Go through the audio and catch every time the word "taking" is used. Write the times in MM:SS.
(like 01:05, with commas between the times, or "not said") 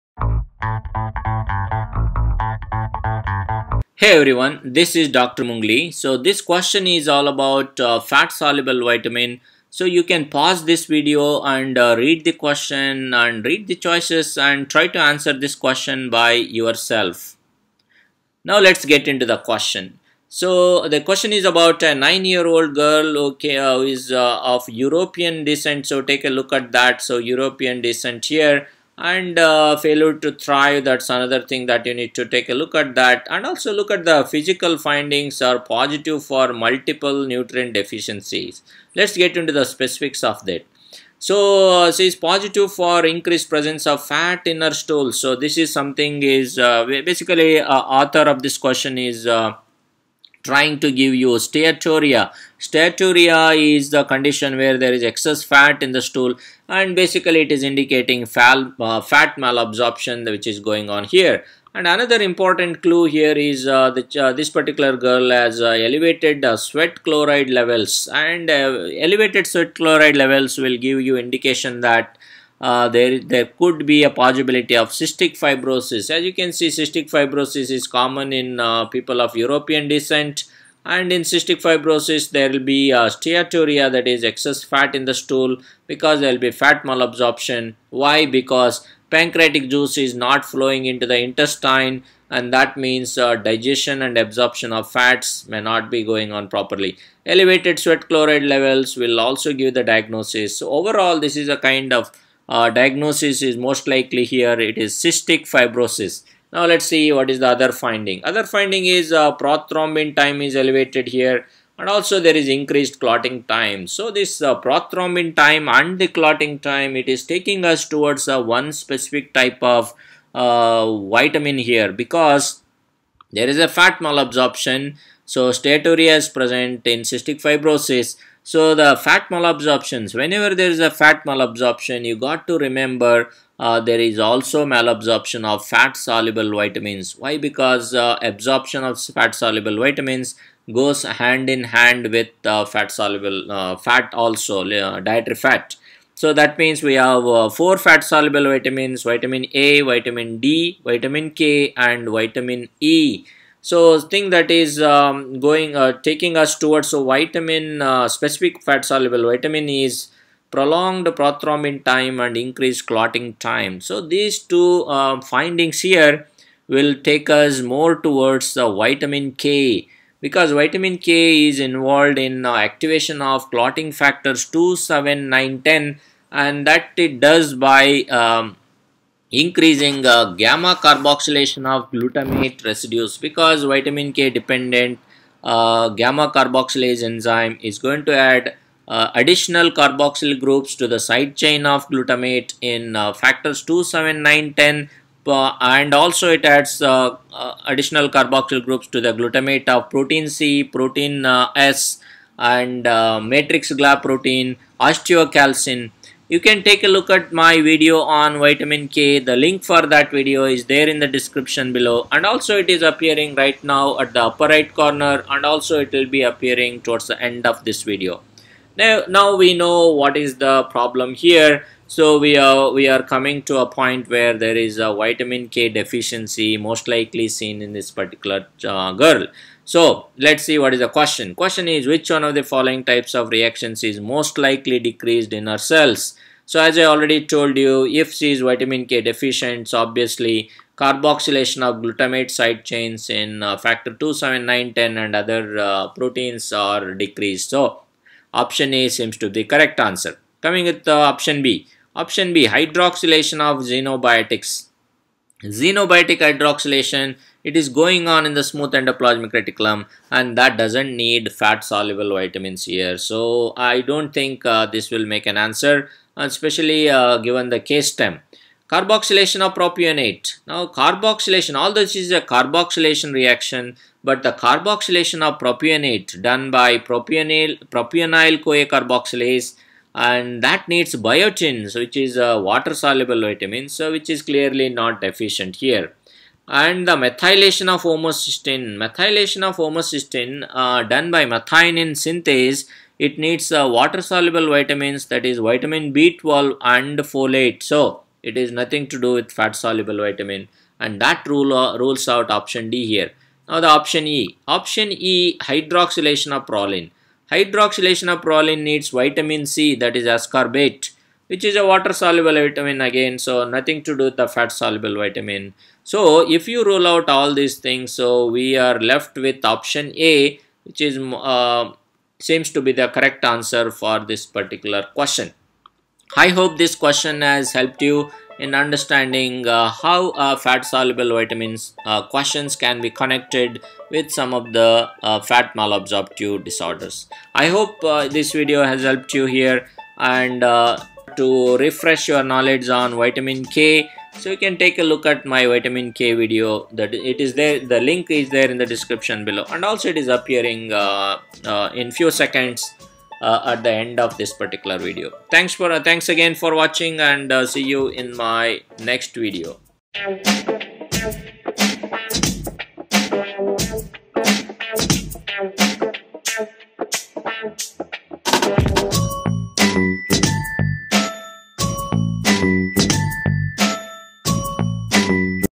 01:57, 02:36.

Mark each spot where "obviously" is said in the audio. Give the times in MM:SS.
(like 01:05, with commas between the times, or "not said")
03:59.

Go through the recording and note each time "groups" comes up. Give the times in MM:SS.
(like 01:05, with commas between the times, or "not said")
03:10, 03:18.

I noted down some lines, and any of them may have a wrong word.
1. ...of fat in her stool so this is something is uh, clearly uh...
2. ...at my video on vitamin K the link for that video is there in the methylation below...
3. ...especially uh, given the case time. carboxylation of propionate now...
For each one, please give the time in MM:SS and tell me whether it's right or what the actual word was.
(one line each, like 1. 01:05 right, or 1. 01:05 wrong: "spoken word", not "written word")
1. 00:43 wrong: "basically", not "clearly"
2. 03:27 wrong: "description", not "methylation"
3. 04:26 right.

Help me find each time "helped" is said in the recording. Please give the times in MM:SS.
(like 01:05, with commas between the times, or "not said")
05:27, 05:38.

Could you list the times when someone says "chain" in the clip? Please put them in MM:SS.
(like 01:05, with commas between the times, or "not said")
03:11, 04:02.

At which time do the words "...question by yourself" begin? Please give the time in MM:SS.
00:15.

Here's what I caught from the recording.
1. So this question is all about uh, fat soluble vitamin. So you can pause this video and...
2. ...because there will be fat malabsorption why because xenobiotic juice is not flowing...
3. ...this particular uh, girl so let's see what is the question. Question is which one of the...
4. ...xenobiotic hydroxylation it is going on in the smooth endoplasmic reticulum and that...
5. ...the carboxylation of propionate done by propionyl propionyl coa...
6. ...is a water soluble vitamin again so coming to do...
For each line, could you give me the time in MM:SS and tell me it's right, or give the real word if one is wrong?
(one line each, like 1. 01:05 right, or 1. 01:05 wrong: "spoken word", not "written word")
1. 00:05 right
2. 01:25 wrong: "pancreatic", not "xenobiotic"
3. 03:47 right
4. 04:15 right
5. 04:34 right
6. 05:11 wrong: "nothing", not "coming".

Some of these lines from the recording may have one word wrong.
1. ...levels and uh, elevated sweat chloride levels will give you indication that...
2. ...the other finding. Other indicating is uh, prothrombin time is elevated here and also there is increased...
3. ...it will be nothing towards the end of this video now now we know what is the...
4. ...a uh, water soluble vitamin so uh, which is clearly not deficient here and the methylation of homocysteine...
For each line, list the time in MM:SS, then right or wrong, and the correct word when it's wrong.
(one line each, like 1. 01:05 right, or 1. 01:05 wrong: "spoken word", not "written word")
1. 01:07 right
2. 01:47 wrong: "finding", not "indicating"
3. 03:35 wrong: "appearing", not "nothing"
4. 04:42 right.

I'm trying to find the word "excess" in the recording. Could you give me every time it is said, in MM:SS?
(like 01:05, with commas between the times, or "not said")
00:55, 01:24.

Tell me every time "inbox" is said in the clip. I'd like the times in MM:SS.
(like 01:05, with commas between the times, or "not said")
not said.